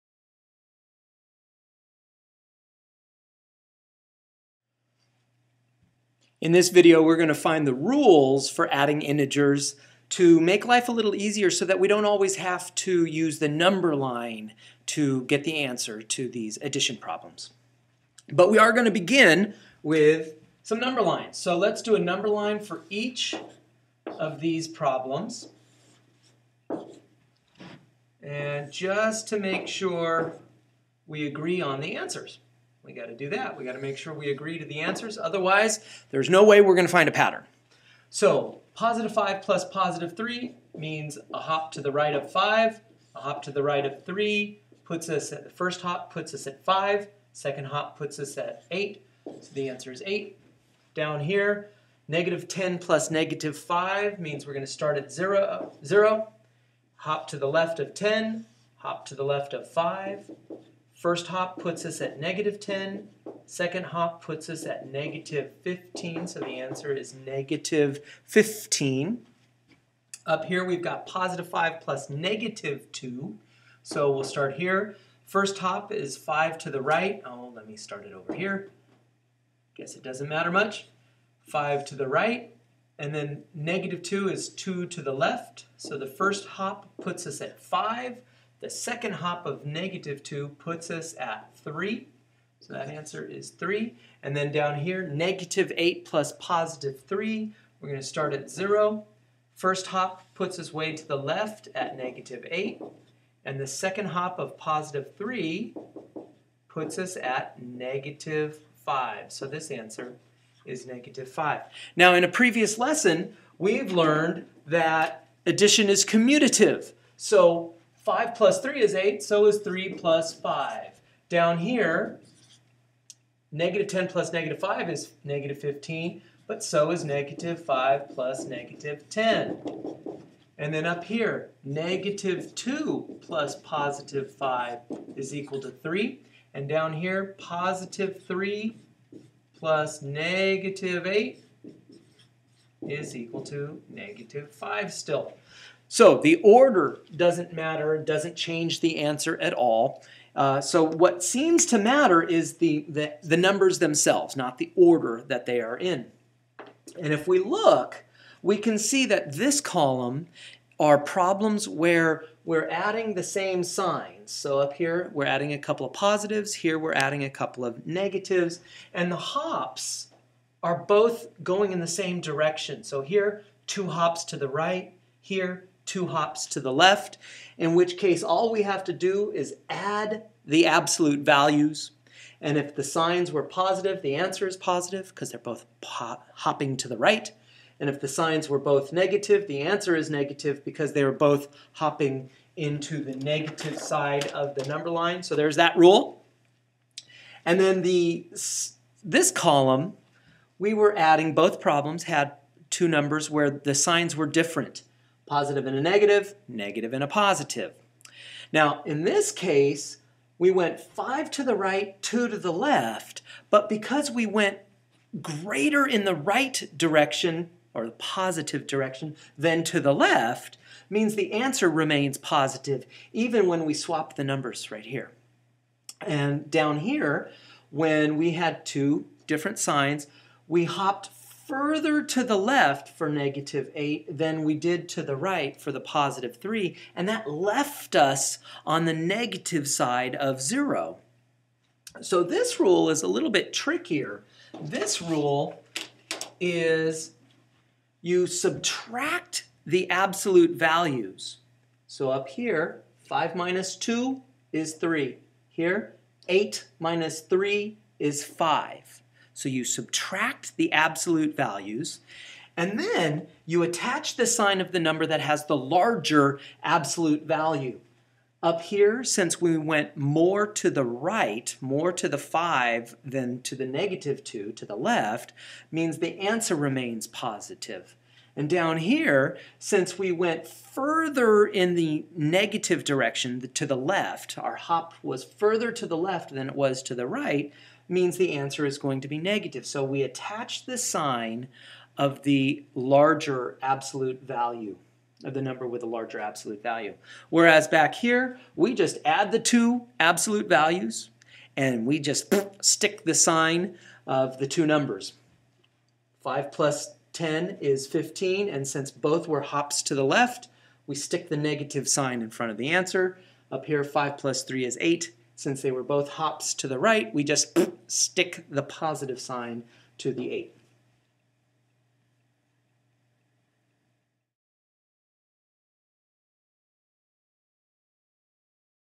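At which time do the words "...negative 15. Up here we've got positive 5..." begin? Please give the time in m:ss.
1:07.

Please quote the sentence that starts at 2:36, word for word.
And if we look, we can see that this column are problems where we're adding the same signs.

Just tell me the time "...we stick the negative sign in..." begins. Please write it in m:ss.
5:10.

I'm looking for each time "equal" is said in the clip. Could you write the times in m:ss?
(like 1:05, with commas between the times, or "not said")
2:15, 2:23.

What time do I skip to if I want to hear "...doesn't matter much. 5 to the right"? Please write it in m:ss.
1:20.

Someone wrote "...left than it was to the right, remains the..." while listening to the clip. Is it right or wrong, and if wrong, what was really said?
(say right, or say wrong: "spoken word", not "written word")
wrong: "means", not "remains".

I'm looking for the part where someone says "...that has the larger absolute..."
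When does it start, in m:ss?
4:25.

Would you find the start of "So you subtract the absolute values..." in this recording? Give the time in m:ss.
4:19.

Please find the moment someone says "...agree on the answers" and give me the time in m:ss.
0:31.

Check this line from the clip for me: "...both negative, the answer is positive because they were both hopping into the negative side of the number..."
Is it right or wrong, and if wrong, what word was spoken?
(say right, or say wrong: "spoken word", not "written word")
wrong: "negative", not "positive".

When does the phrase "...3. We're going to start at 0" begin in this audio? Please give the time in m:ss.
1:37.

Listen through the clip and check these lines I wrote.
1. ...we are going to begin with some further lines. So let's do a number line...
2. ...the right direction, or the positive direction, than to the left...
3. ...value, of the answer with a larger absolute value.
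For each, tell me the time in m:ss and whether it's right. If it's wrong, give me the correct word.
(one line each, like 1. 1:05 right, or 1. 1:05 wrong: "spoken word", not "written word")
1. 0:18 wrong: "number", not "further"
2. 3:36 right
3. 4:54 wrong: "number", not "answer".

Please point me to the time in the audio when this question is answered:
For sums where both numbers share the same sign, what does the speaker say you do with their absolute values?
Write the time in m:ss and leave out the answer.
2:59.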